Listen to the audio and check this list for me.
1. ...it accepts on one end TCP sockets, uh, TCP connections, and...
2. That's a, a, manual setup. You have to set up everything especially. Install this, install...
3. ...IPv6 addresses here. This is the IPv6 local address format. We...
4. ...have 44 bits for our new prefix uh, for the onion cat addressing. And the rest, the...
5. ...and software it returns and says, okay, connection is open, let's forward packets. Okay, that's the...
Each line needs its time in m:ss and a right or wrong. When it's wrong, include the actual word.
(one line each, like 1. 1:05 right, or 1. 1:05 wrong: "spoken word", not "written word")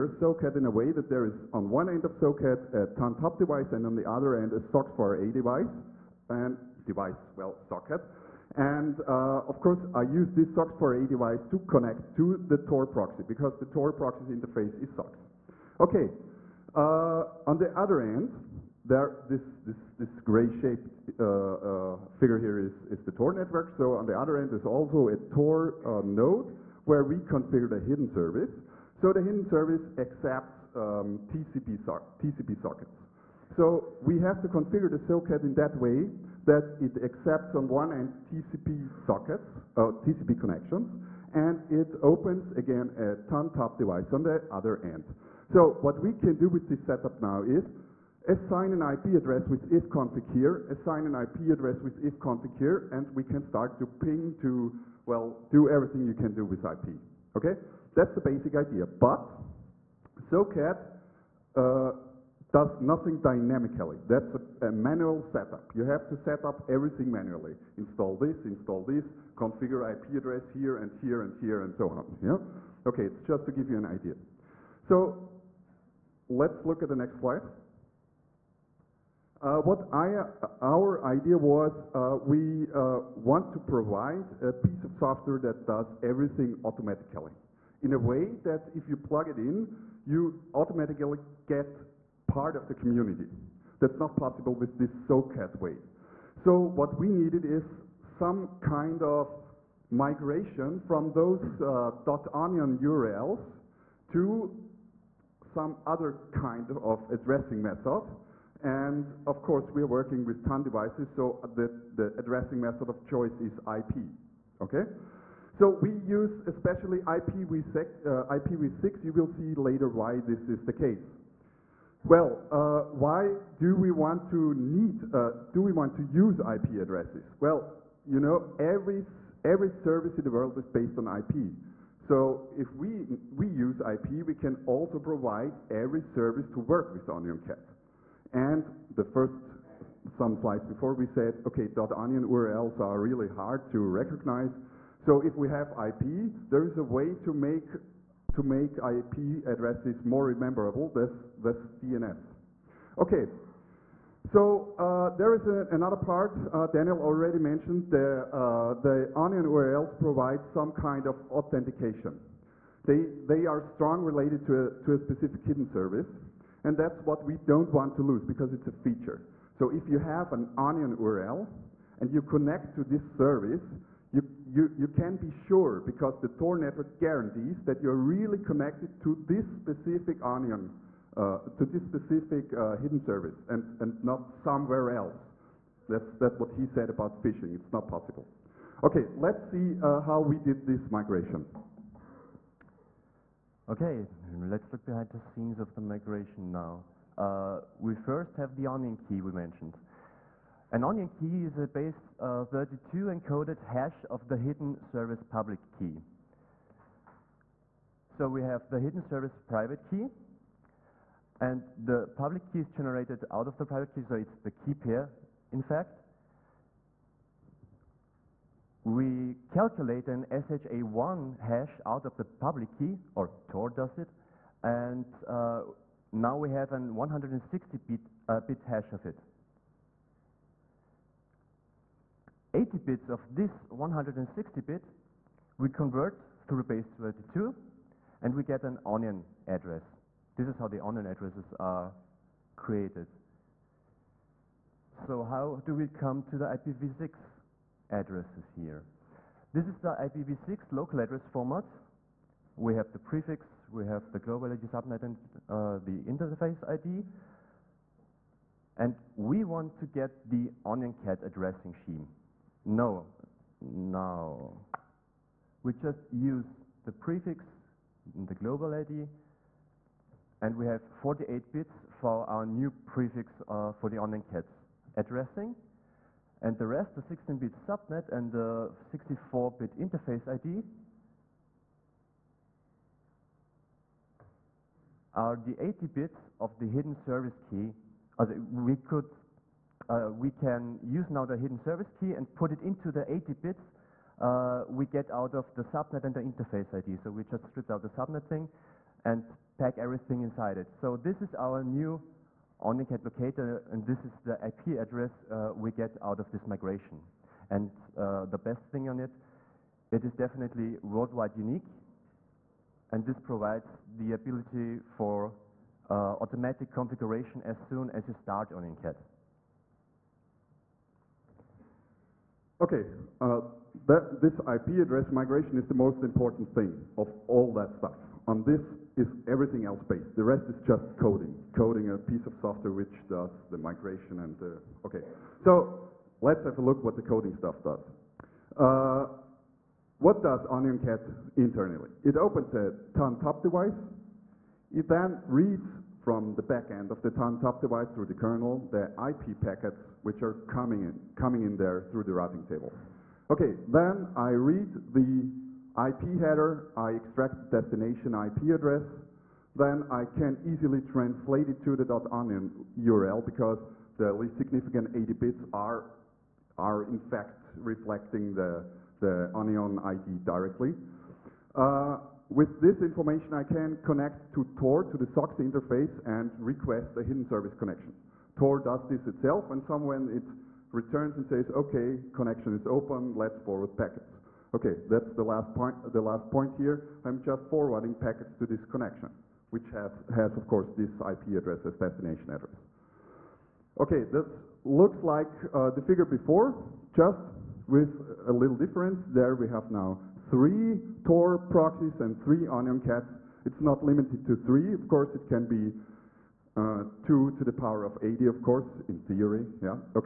1. 0:36 right
2. 1:04 wrong: "manually", not "especially"
3. 4:06 right
4. 4:30 wrong: "48", not "44"
5. 6:19 wrong: "somewhere", not "software".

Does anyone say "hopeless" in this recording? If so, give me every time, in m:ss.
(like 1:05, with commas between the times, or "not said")
not said.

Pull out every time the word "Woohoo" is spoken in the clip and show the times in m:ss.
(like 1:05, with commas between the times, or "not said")
not said.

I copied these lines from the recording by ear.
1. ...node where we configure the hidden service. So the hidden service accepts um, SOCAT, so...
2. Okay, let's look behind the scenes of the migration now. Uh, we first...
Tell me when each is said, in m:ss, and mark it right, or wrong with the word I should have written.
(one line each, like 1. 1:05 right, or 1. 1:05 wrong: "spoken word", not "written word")
1. 0:26 wrong: "TCP", not "SOCAT"
2. 3:13 right.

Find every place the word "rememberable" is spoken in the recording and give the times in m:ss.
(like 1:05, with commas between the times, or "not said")
2:30.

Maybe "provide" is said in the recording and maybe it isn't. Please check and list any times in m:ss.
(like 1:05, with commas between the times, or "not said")
1:23, 2:14, 2:39, 5:13.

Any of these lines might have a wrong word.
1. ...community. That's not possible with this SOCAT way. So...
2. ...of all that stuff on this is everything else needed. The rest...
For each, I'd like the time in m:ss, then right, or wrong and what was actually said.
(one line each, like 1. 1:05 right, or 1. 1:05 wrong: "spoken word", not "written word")
1. 1:32 right
2. 5:26 wrong: "based", not "needed".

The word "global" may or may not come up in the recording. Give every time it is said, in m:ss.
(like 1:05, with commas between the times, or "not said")
4:14, 4:28.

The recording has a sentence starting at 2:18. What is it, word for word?
And the first some slides before we said, okay, .onion URLs are really hard to recognize.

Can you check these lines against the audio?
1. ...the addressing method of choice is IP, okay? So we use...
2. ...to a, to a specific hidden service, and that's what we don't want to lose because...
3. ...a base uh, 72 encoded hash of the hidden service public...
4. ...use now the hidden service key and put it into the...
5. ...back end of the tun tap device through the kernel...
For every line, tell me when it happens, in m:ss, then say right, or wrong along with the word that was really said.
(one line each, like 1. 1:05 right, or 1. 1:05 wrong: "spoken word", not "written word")
1. 1:51 right
2. 2:44 right
3. 3:21 wrong: "32", not "72"
4. 4:50 right
5. 5:46 right.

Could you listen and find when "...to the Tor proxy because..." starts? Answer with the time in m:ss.
0:12.